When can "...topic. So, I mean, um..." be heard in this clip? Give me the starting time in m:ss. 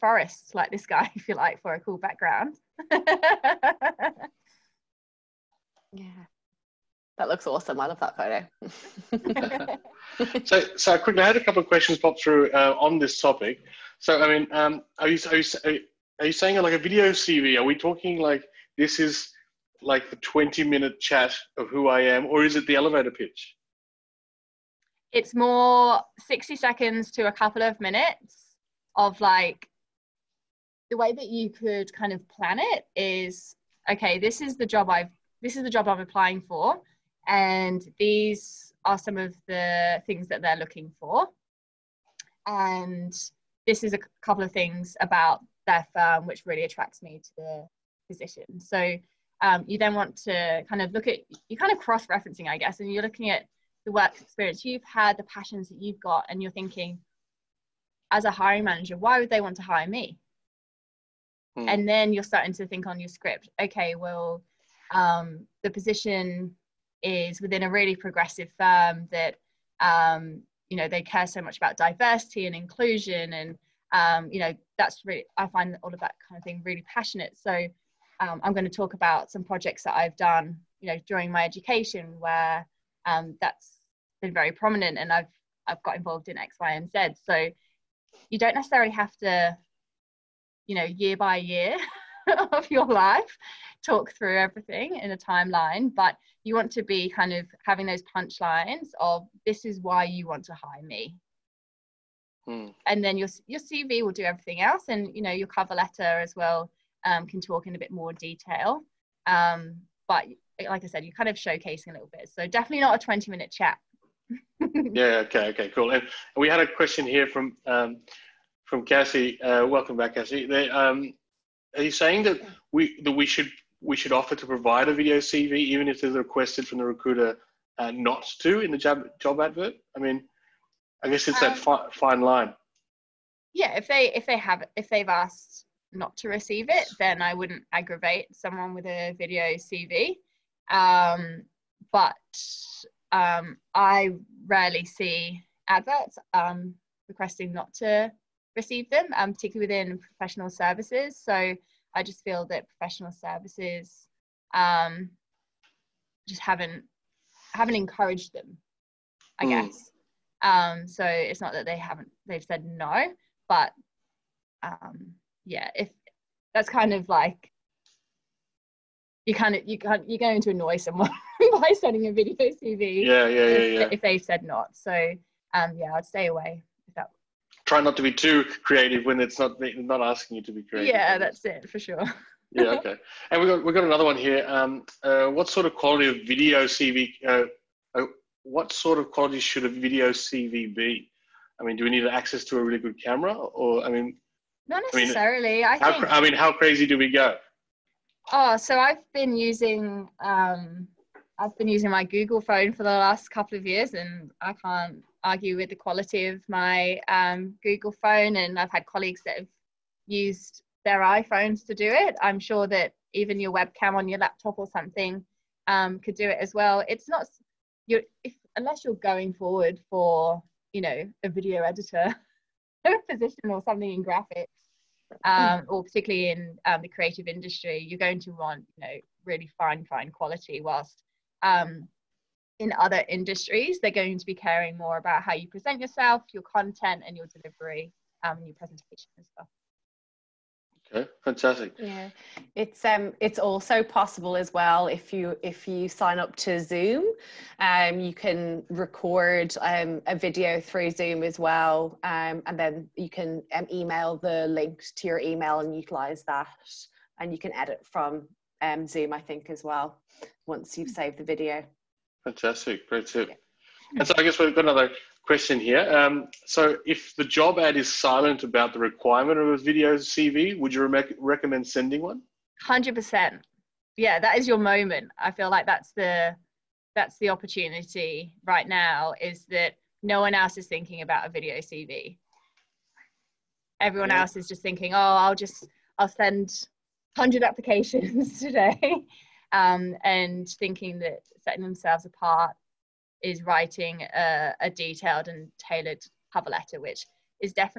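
0:13.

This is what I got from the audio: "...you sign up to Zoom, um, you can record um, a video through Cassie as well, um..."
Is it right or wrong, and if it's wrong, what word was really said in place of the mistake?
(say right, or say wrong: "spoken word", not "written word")
wrong: "Zoom", not "Cassie".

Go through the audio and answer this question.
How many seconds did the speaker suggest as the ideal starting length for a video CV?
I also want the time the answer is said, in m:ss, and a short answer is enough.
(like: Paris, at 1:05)
60 seconds, at 0:26.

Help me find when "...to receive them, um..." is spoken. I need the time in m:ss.
2:27.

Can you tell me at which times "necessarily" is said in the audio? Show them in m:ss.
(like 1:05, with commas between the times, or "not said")
1:28, 3:14.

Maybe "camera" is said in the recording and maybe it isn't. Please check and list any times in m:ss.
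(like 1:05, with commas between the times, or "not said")
3:13.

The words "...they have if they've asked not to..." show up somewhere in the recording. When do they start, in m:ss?
2:14.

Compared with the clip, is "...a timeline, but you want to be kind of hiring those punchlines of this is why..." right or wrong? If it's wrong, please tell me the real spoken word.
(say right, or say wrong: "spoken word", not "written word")
wrong: "having", not "hiring".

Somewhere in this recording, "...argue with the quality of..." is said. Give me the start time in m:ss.
3:25.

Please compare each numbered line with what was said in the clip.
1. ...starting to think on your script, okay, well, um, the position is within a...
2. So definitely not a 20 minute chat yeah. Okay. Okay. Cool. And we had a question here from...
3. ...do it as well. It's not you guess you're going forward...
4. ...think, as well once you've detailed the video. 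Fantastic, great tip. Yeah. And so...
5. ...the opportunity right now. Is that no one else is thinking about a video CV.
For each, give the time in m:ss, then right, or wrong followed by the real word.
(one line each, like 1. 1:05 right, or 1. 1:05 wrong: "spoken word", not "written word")
1. 1:02 right
2. 1:52 right
3. 3:36 wrong: "unless", not "guess"
4. 4:19 wrong: "saved", not "detailed"
5. 4:37 right.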